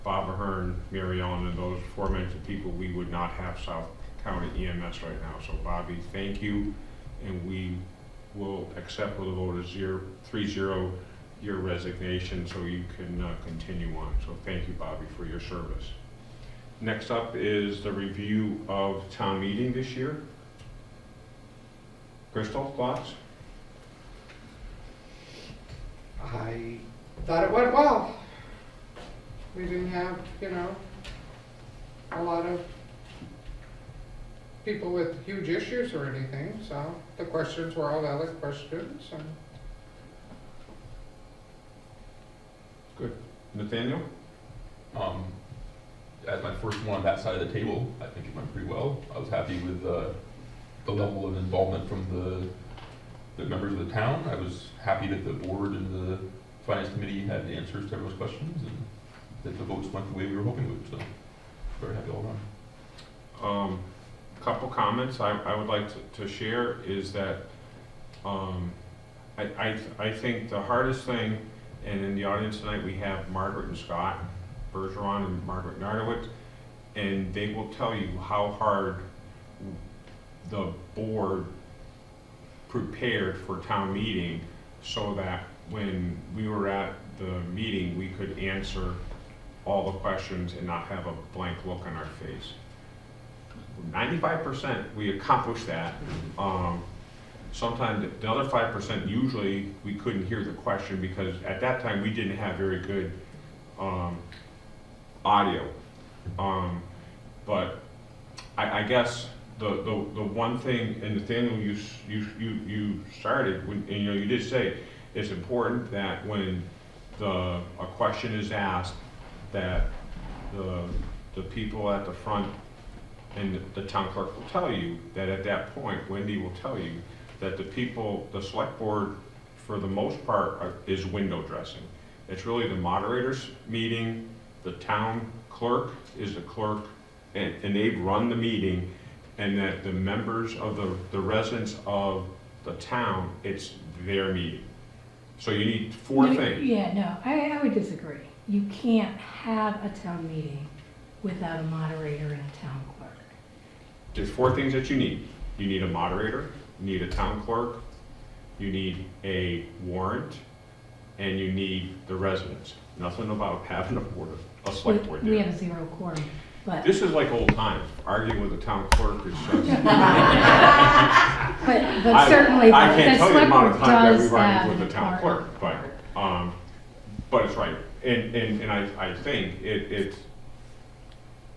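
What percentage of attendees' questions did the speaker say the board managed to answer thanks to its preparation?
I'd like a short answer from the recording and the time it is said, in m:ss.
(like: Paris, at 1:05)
95%, at 1:33.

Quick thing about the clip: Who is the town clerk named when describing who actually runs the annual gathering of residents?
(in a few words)
Wendy.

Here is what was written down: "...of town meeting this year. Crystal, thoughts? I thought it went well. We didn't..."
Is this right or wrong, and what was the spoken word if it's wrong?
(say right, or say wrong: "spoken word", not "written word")
right.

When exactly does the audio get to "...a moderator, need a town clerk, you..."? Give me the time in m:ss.
2:35.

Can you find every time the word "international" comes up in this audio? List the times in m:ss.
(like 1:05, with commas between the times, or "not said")
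not said.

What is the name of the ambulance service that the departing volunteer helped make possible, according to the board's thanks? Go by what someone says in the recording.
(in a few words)
South County EMS.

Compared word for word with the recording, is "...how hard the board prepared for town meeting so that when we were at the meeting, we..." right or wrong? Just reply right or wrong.
right.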